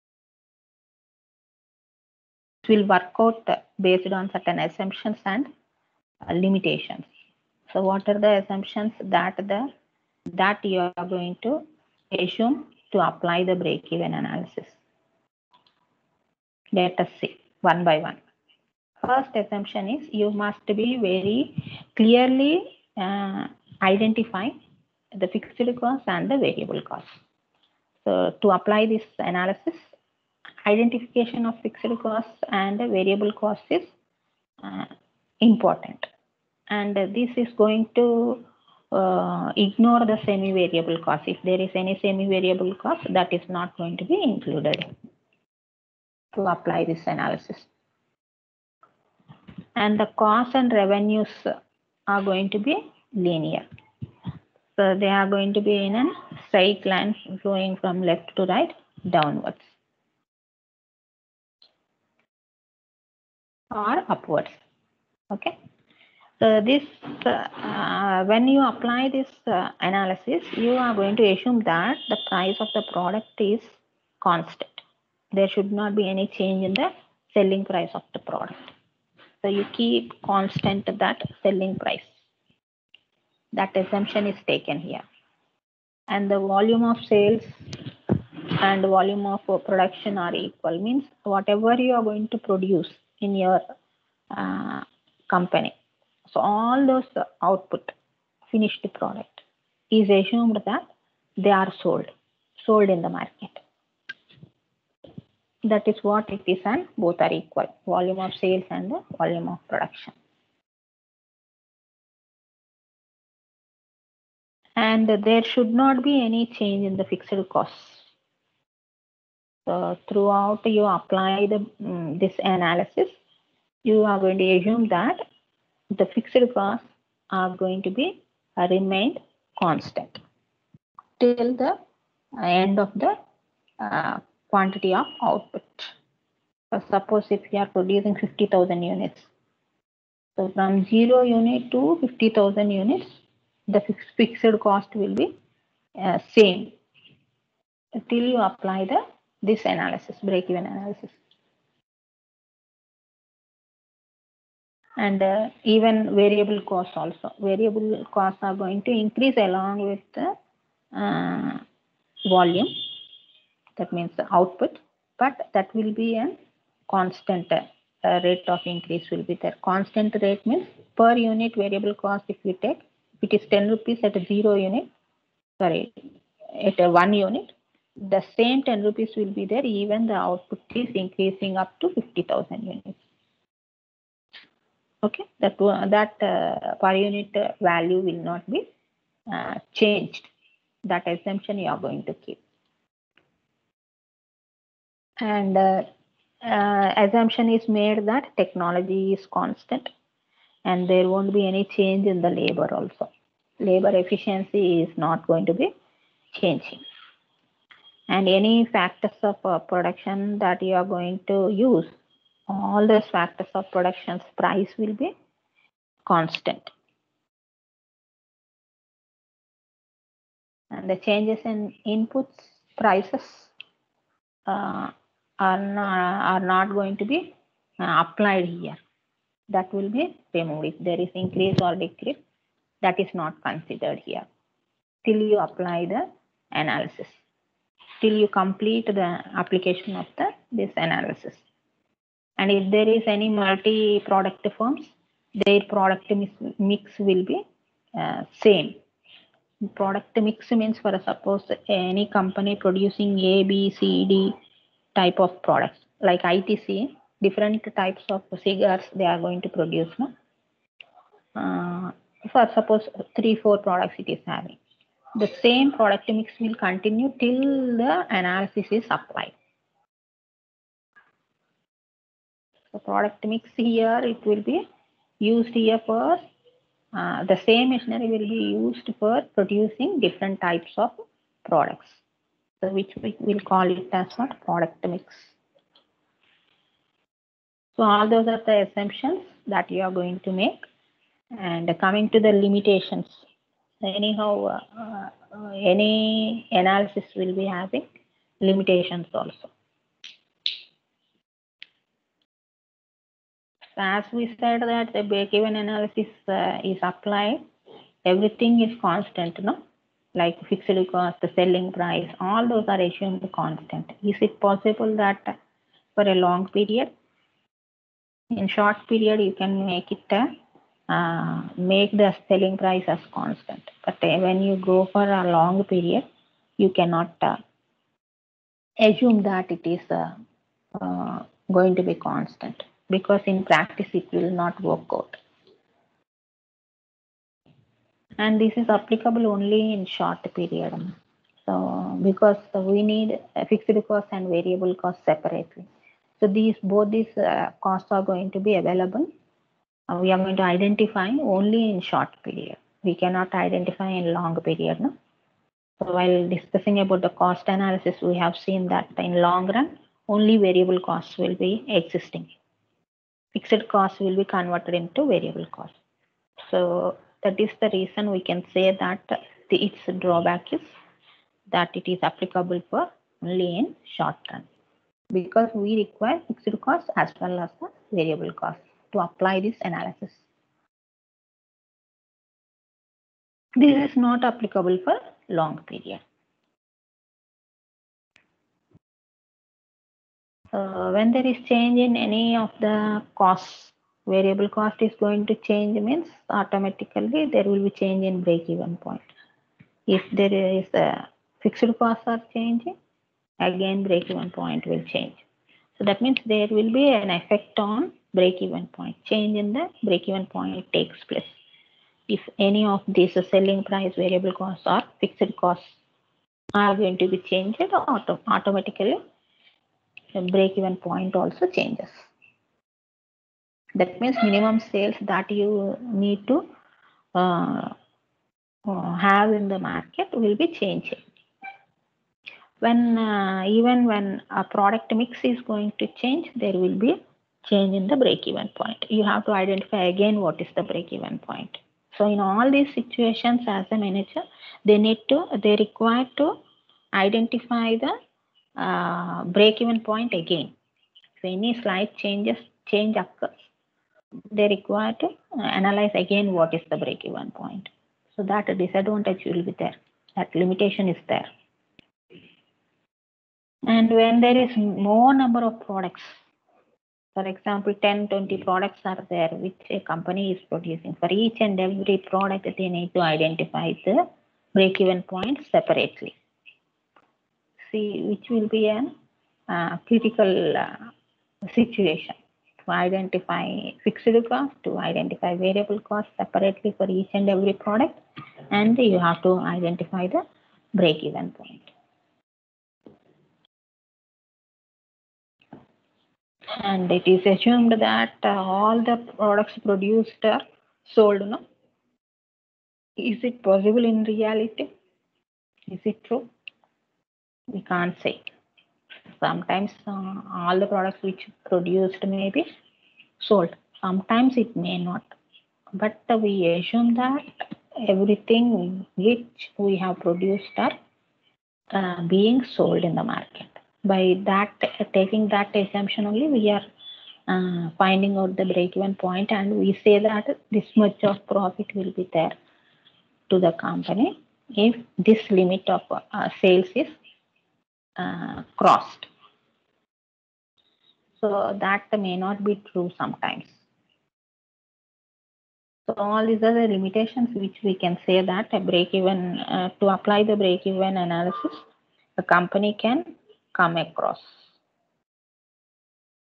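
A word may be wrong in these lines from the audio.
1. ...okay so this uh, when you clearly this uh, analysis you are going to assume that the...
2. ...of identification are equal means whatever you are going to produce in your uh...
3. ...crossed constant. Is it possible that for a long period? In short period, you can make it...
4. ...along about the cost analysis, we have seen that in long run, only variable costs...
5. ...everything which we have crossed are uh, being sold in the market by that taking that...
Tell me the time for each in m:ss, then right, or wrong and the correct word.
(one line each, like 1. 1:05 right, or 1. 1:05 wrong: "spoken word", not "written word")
1. 1:05 wrong: "apply", not "clearly"
2. 1:29 wrong: "production", not "identification"
3. 5:12 wrong: "assumed", not "crossed"
4. 5:56 wrong: "discussing", not "along"
5. 8:37 wrong: "produced", not "crossed".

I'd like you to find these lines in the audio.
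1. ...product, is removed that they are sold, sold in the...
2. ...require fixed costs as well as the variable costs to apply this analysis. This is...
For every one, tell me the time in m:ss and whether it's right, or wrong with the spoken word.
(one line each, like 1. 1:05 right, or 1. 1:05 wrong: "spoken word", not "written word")
1. 1:38 wrong: "assumed", not "removed"
2. 6:15 right.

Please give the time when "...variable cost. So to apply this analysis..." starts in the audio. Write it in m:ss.
0:26.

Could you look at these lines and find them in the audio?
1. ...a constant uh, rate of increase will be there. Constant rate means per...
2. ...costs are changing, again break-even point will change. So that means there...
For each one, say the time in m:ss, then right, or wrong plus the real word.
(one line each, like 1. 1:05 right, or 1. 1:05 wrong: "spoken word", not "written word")
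1. 2:46 right
2. 6:41 right.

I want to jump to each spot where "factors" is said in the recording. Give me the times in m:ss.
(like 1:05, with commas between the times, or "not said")
3:28, 3:33.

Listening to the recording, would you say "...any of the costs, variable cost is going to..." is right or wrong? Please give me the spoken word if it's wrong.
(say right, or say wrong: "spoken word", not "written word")
right.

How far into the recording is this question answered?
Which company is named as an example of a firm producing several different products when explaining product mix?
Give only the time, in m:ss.
4:16.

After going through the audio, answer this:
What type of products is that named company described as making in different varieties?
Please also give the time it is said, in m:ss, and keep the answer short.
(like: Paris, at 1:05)
Cigars, at 4:18.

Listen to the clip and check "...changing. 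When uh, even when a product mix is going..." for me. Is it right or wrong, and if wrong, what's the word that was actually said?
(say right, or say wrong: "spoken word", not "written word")
right.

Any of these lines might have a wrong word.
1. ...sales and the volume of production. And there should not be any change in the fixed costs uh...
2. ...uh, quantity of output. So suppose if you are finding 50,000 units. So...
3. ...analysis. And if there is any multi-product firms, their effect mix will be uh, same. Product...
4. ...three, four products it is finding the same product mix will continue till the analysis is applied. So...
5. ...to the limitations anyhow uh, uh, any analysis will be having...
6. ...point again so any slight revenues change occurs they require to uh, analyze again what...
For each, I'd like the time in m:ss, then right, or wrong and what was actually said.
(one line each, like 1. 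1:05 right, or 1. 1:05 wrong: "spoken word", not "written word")
1. 1:48 right
2. 2:13 wrong: "producing", not "finding"
3. 4:00 wrong: "product", not "effect"
4. 4:23 wrong: "having", not "finding"
5. 4:52 right
6. 7:29 wrong: "changes", not "revenues".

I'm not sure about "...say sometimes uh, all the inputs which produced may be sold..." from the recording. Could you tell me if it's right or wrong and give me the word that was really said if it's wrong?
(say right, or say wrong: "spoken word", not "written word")
wrong: "products", not "inputs".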